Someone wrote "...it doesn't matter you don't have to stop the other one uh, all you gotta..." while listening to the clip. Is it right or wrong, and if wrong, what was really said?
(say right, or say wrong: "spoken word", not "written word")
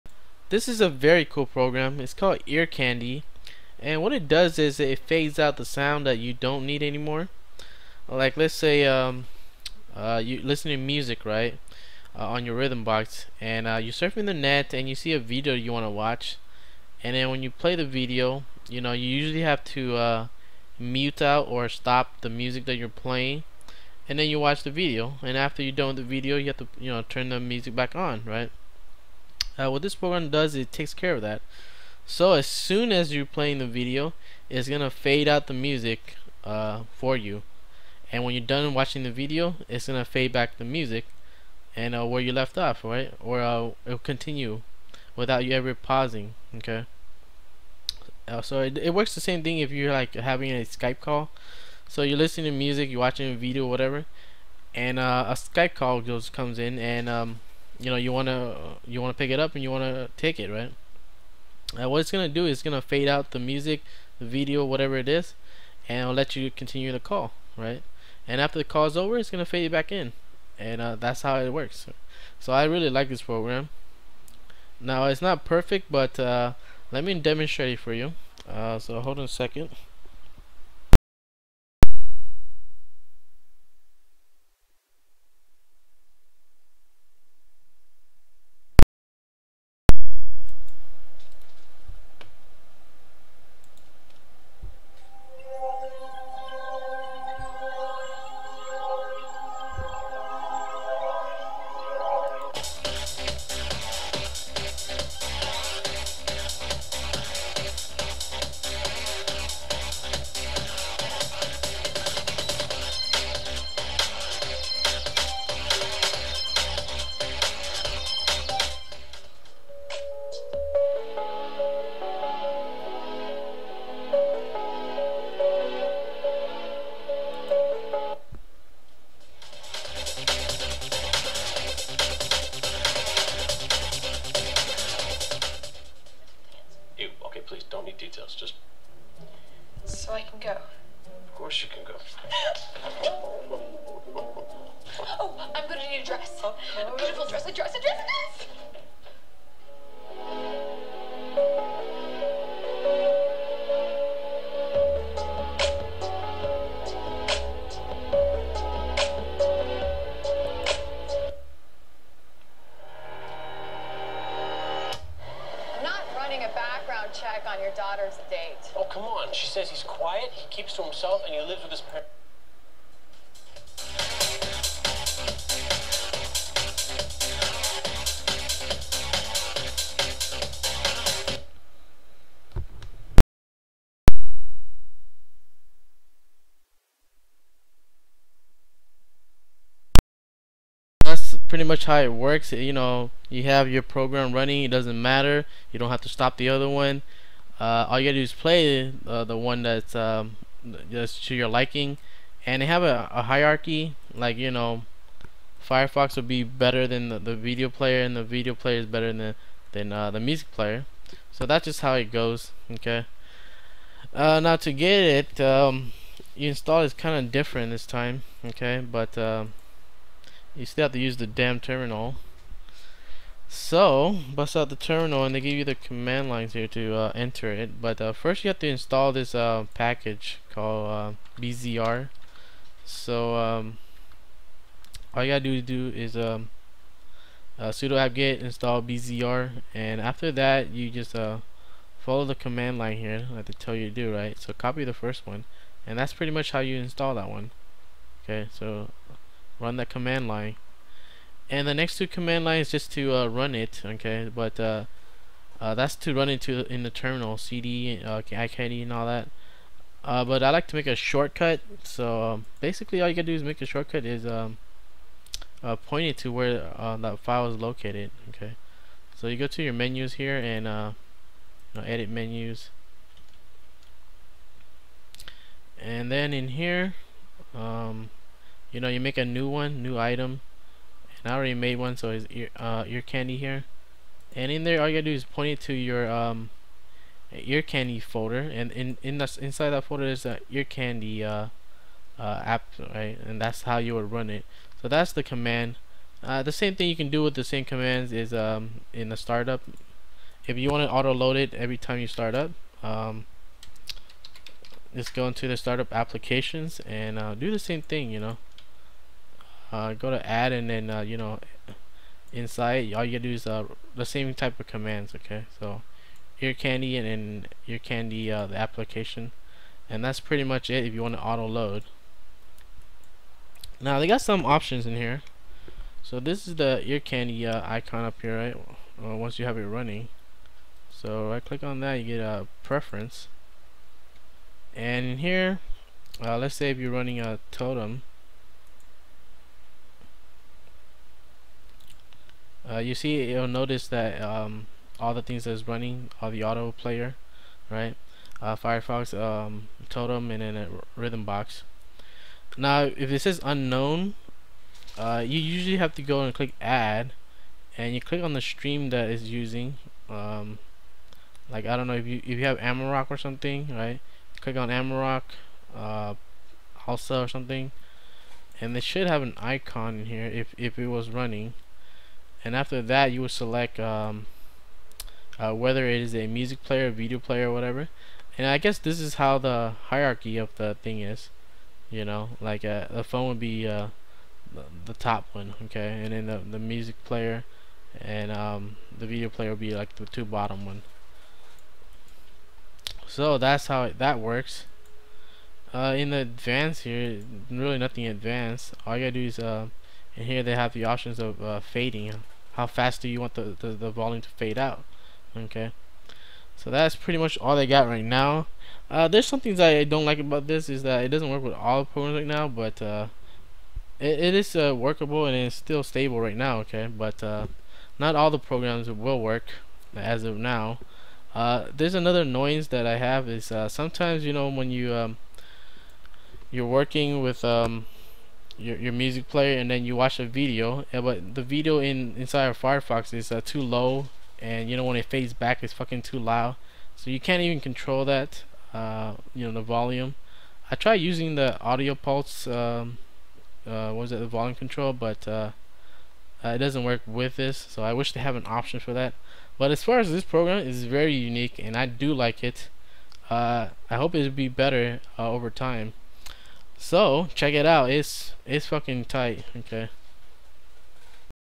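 right.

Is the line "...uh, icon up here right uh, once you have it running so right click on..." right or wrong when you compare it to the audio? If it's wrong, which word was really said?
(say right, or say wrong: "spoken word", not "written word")
right.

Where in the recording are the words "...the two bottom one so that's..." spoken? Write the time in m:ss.
6:29.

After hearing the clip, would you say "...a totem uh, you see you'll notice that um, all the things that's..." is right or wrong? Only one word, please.
right.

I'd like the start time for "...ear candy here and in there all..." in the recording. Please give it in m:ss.
4:42.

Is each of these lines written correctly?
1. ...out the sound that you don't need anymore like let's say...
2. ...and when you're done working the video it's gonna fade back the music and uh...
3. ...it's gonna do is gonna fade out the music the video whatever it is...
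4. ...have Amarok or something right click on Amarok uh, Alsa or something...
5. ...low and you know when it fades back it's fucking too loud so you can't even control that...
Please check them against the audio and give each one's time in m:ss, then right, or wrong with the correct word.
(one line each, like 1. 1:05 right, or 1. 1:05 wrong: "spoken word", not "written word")
1. 0:05 right
2. 0:38 wrong: "watching", not "working"
3. 1:01 right
4. 6:02 right
5. 7:13 right.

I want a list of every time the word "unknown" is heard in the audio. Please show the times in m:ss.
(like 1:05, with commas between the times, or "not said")
5:53.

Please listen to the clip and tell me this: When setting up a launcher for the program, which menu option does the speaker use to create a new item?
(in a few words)
edit menus.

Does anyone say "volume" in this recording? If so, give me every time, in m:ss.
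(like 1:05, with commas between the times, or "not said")
6:43, 7:19, 7:24.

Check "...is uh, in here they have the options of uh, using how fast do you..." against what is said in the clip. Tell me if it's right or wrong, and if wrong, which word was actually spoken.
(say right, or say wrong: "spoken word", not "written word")
wrong: "fading", not "using".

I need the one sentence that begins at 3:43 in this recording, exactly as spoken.
So, bust out the terminal and they give you the command lines here to uh, enter it.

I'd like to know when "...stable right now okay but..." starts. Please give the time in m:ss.
6:55.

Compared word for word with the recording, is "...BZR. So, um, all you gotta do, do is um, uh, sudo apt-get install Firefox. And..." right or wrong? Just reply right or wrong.
wrong.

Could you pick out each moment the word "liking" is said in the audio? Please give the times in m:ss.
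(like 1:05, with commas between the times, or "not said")
3:21.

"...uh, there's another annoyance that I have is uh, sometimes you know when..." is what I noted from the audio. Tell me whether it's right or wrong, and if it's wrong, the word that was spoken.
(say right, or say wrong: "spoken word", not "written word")
right.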